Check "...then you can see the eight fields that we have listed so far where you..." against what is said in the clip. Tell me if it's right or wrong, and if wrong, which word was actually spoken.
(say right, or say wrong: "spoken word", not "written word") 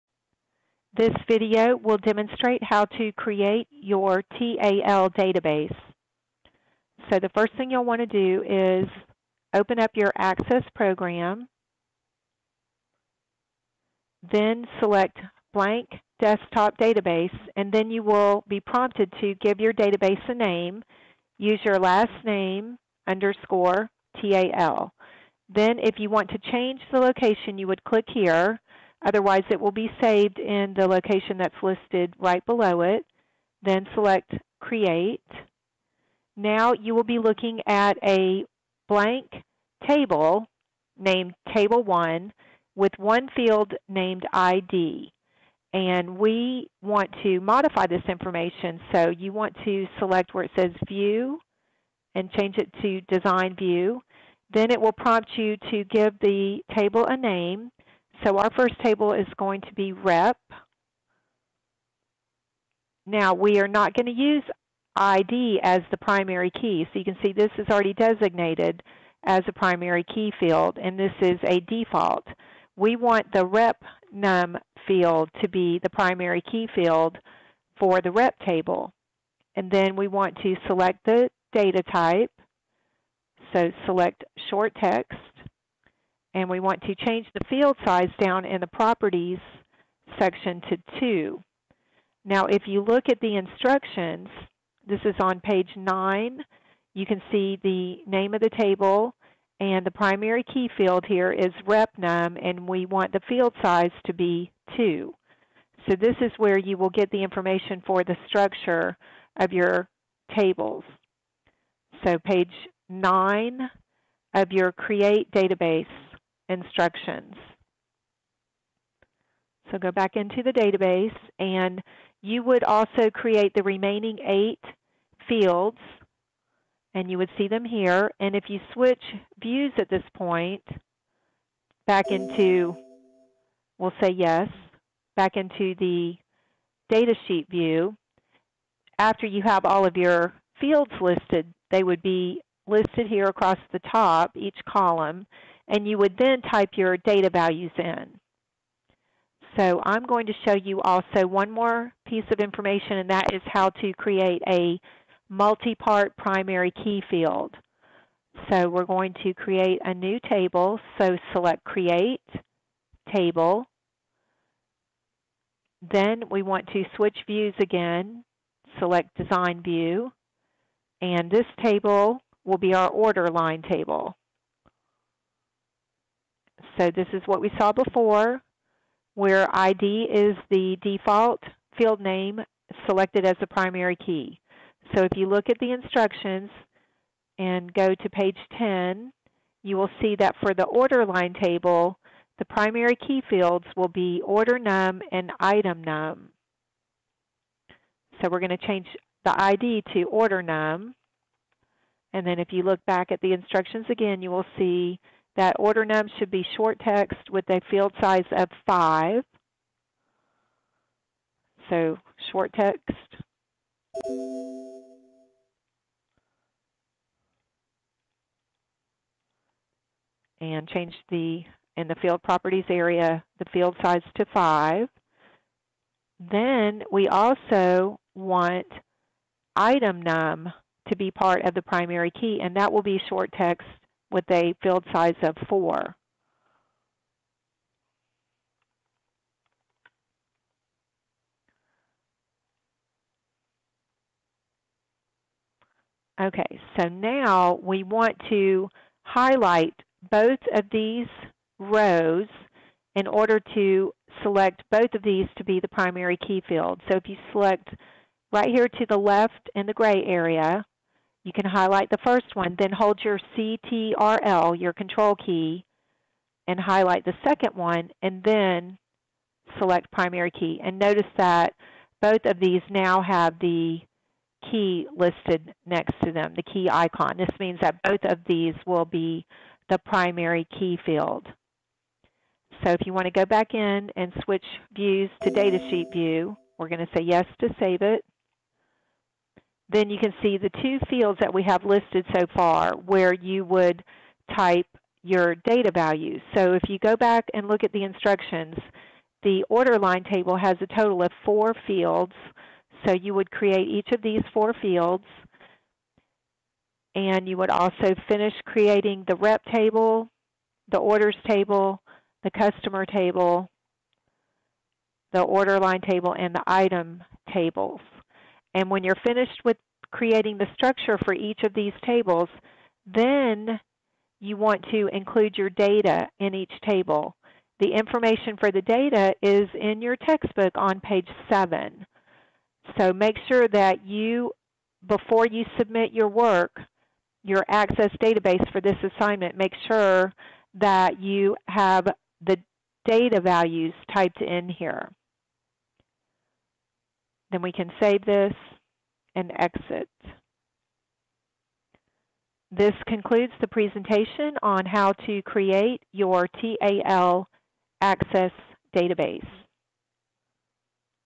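wrong: "two", not "eight".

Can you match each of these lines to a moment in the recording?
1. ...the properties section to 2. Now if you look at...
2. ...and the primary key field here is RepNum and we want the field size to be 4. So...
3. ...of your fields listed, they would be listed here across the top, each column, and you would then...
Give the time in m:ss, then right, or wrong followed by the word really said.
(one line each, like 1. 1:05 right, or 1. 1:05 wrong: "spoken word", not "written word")
1. 1:28 right
2. 1:39 wrong: "2", not "4"
3. 2:19 right.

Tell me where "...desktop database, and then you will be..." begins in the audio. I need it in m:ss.
0:16.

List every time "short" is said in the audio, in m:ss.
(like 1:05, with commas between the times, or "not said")
1:24, 3:26, 3:32, 3:53.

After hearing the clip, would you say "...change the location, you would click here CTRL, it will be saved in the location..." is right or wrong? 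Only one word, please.
wrong.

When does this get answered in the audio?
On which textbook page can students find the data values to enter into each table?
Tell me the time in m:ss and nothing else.
5:29.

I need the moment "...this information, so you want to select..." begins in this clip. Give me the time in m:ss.
0:47.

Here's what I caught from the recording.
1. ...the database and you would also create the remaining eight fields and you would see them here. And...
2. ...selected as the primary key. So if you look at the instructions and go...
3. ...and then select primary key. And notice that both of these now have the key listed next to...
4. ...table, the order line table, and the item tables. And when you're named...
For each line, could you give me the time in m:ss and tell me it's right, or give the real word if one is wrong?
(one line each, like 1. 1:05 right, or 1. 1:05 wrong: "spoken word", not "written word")
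1. 2:00 right
2. 3:02 right
3. 4:28 right
4. 5:12 wrong: "finished", not "named".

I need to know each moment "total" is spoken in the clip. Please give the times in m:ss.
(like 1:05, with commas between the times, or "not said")
5:00.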